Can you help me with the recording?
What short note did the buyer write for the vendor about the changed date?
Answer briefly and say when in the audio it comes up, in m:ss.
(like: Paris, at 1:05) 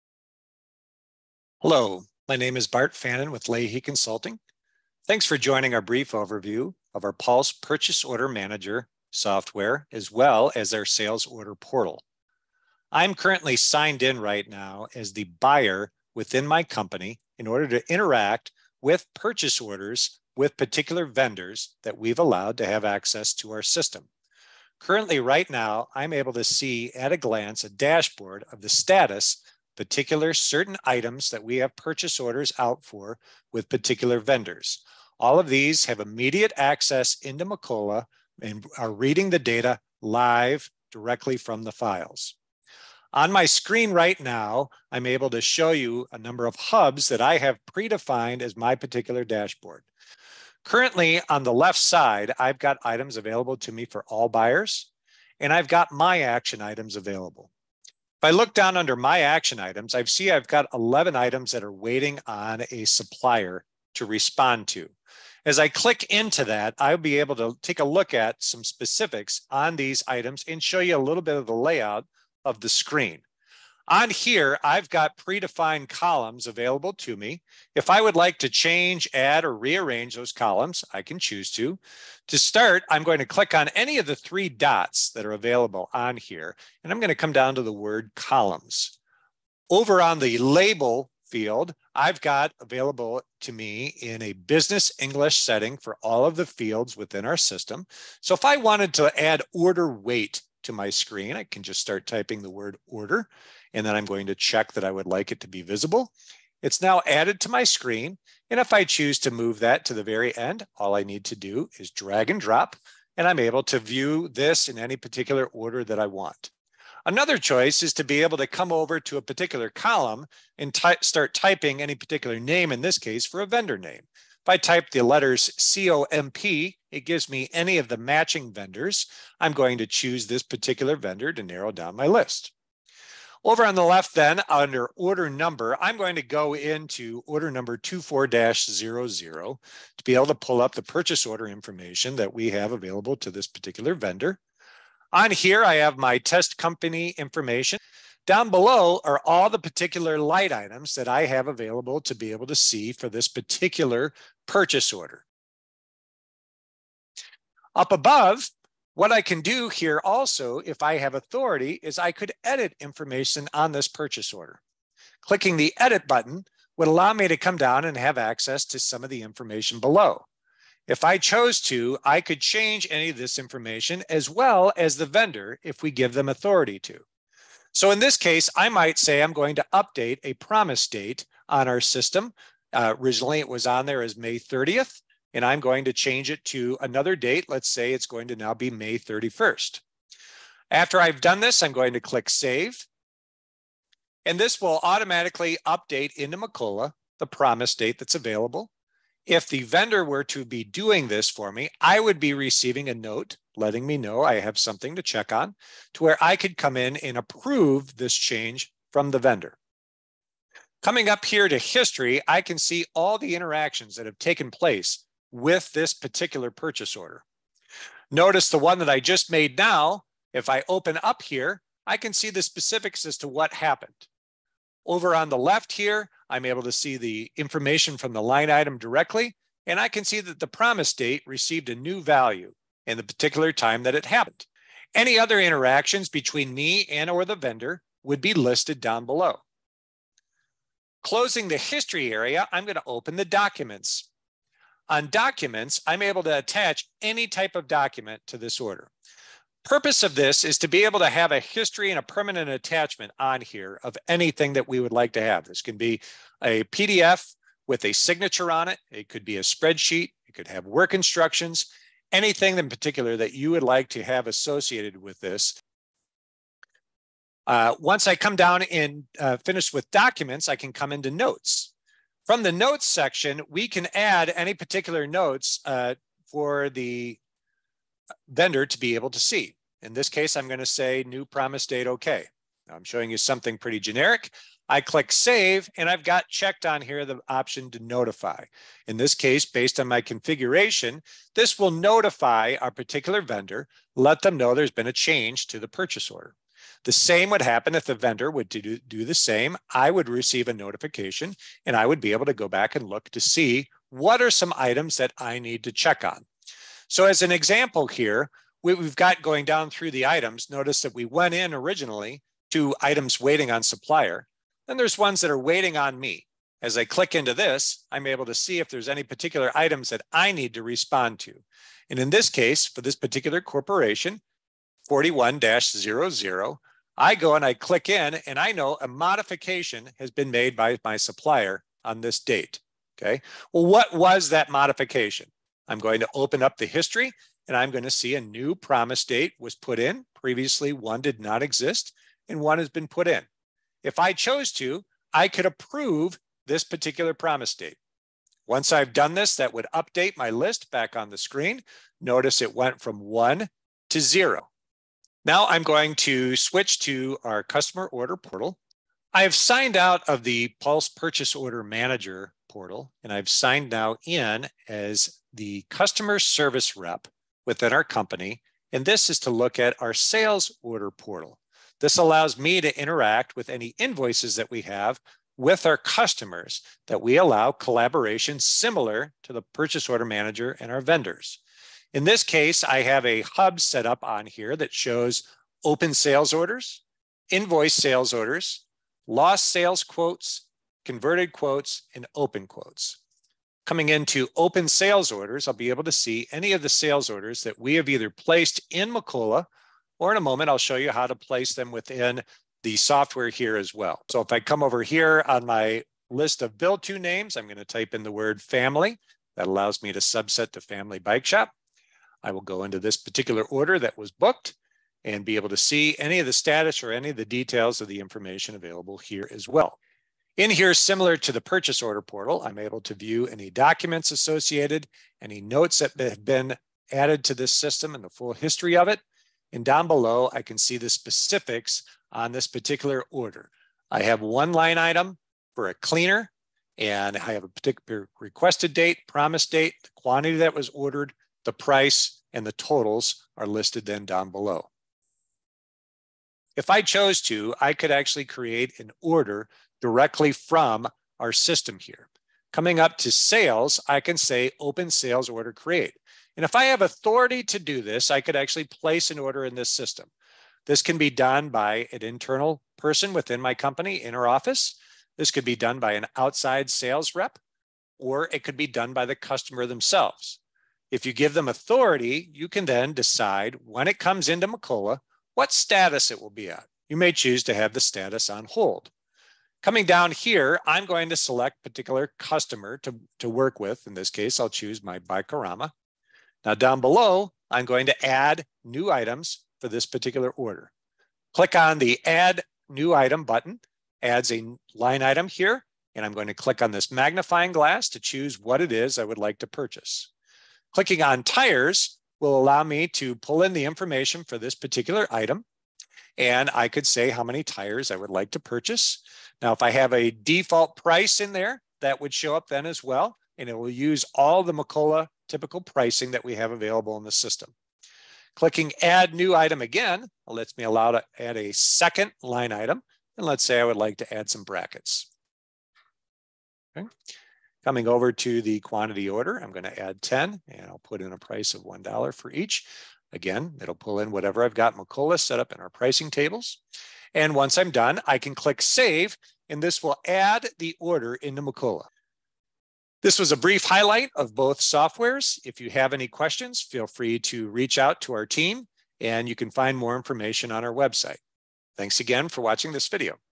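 New promise date OK, at 4:41.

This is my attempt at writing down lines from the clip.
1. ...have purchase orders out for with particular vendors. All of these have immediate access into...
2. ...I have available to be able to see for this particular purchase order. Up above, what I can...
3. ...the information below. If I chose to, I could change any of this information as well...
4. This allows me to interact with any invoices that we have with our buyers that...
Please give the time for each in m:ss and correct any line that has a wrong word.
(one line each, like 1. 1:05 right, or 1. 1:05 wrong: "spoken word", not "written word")
1. 0:31 right
2. 2:31 right
3. 2:49 right
4. 6:11 wrong: "customers", not "buyers".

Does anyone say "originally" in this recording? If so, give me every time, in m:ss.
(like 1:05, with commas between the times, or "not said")
3:02, 5:11.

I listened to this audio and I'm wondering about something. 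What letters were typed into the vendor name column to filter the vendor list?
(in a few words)
COMP.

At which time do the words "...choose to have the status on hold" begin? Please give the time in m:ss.
7:57.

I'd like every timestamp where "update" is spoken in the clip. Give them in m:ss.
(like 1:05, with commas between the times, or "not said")
2:59, 3:15, 5:49.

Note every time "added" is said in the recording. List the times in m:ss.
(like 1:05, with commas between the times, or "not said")
1:47, 7:06.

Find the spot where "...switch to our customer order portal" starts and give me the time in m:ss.
5:56.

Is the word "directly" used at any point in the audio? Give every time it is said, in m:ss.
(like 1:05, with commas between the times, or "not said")
0:40, 3:48, 7:29.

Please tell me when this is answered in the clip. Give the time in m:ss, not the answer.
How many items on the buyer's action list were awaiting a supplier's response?
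1:00.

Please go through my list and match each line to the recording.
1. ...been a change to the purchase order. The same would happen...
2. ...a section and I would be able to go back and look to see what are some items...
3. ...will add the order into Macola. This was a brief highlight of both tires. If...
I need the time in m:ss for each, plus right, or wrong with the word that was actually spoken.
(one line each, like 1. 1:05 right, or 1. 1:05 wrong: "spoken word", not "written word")
1. 4:54 right
2. 5:00 wrong: "notification", not "section"
3. 8:59 wrong: "softwares", not "tires".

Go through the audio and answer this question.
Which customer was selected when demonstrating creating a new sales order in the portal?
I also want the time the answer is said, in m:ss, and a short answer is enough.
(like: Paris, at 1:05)
Bikorama, at 8:04.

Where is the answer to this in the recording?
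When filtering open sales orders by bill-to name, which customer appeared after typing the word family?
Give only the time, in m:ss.
6:50.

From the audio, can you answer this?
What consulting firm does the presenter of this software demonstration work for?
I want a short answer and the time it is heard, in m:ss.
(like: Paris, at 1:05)
Leahy Consulting, at 0:03.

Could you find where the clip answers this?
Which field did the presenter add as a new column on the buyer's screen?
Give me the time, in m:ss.
1:39.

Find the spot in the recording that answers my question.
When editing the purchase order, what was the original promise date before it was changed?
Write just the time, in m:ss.
3:04.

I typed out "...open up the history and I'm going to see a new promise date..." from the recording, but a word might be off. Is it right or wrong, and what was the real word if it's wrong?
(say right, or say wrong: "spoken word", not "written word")
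right.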